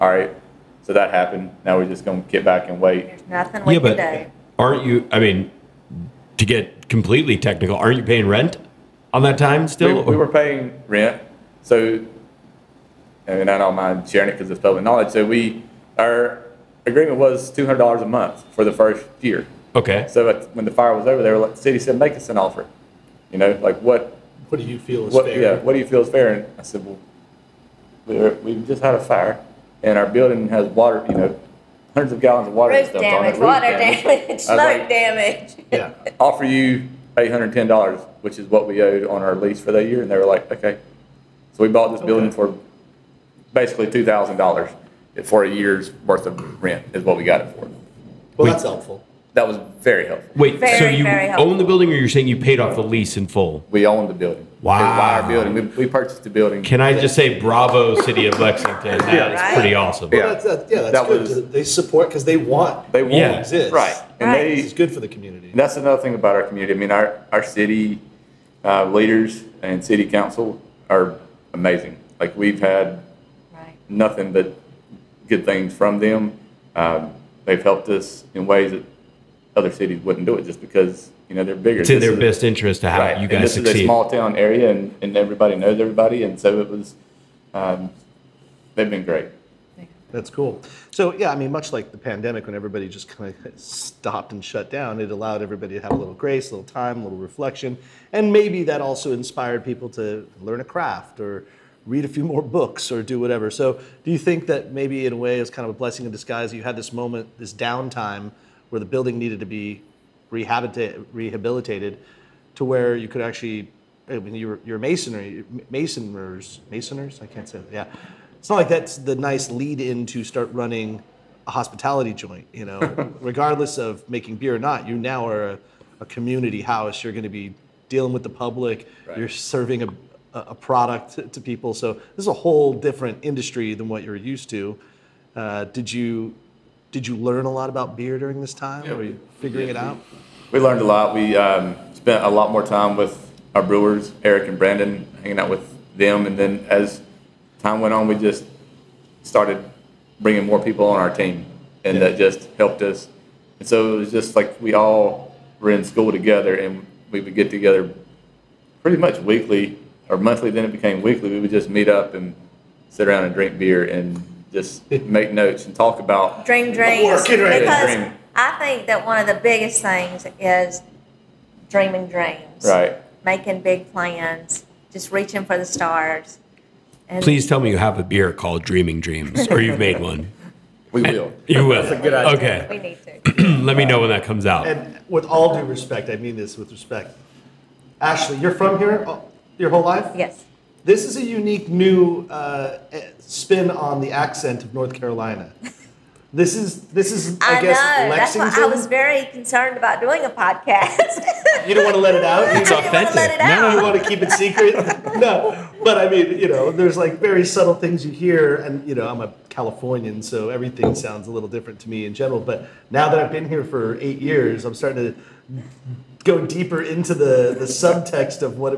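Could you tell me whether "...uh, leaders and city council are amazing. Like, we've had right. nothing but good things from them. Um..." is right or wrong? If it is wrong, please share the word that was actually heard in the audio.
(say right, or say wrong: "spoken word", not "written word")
right.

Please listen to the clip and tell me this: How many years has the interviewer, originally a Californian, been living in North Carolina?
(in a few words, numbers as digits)
8.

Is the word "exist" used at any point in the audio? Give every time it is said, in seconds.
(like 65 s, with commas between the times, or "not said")
63 s.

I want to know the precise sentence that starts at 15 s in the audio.
So we, our agreement was $200 a month for the first year.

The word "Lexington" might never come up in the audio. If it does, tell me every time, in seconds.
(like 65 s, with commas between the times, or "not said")
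58 s, 198 s.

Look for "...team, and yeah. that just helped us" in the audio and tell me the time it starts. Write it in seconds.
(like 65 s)
151 s.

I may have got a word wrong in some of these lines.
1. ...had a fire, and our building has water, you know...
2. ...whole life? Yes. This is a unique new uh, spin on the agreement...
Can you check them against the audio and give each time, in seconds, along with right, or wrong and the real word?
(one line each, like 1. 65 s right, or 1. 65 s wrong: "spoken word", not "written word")
1. 28 s right
2. 189 s wrong: "accent", not "agreement".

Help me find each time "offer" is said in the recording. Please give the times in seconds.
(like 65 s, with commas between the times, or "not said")
22 s, 36 s.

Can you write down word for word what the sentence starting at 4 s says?
Aren't you, I mean, to get completely technical, aren't you paying rent on that time still?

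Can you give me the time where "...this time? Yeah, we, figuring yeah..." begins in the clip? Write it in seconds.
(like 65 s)
138 s.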